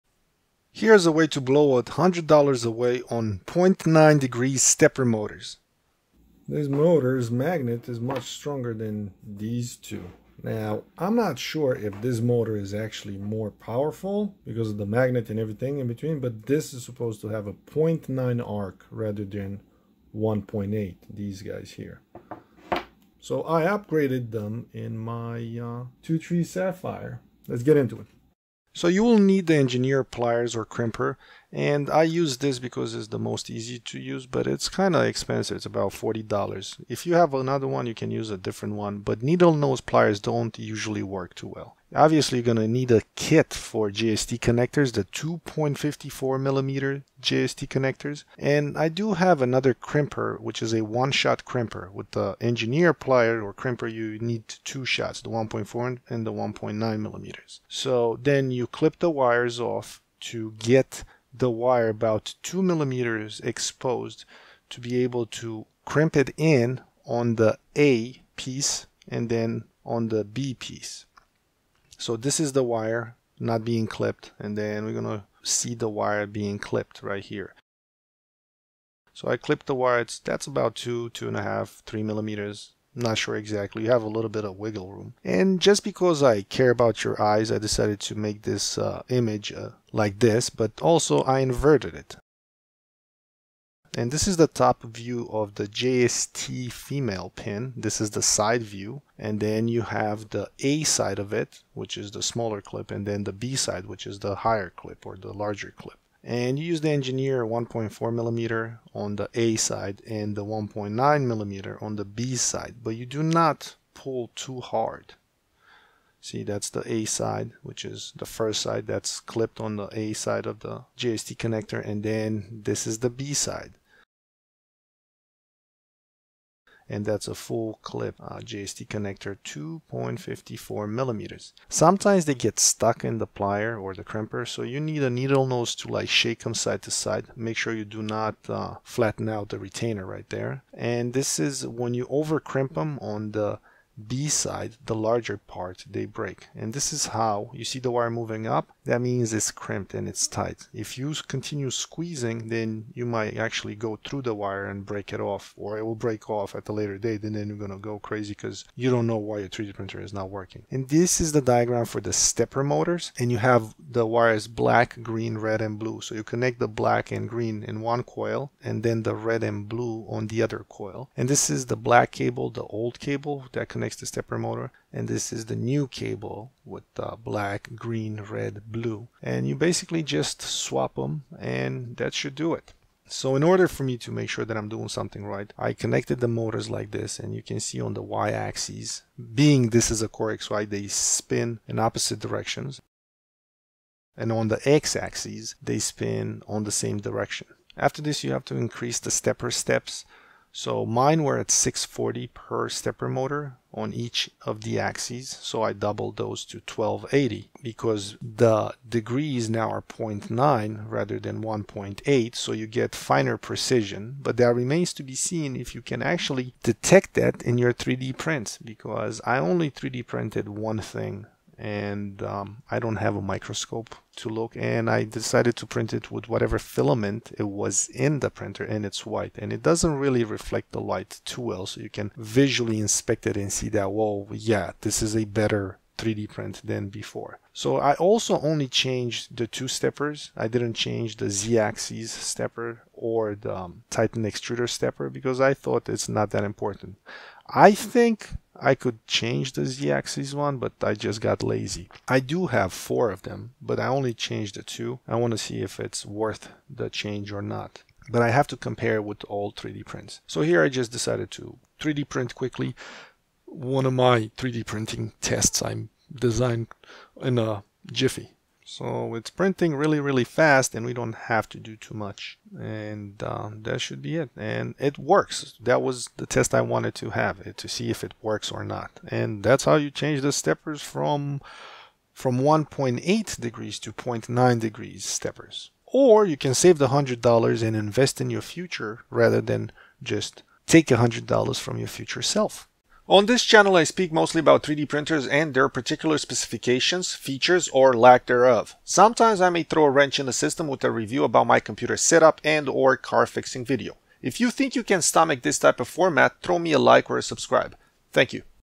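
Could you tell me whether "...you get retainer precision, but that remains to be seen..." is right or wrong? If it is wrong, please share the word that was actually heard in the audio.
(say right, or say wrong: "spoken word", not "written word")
wrong: "finer", not "retainer".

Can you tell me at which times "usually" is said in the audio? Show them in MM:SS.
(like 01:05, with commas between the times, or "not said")
00:40.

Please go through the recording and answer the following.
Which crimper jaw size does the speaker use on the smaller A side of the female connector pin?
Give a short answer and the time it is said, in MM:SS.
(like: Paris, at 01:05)
1.4 millimeter, at 01:47.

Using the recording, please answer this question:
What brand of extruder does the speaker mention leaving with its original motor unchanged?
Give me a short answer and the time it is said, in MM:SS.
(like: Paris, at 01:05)
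Titan, at 04:03.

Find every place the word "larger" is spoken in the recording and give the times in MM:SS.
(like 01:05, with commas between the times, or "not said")
01:45, 02:24.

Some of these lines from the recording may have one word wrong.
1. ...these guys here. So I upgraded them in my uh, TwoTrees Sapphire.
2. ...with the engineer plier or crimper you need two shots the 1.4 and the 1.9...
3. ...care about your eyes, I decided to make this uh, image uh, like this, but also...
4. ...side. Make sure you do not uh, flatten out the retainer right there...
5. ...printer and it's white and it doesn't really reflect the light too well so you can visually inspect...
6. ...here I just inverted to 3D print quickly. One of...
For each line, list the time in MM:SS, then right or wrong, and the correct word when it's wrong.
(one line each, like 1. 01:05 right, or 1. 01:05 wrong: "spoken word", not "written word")
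1. 00:21 right
2. 00:51 right
3. 01:26 right
4. 02:16 right
5. 03:48 right
6. 04:20 wrong: "decided", not "inverted".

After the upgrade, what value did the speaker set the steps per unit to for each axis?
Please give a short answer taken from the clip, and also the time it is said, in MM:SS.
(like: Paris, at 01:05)
1280, at 03:26.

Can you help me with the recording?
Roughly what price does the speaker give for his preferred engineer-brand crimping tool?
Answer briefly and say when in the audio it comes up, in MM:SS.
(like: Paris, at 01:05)
$40, at 00:35.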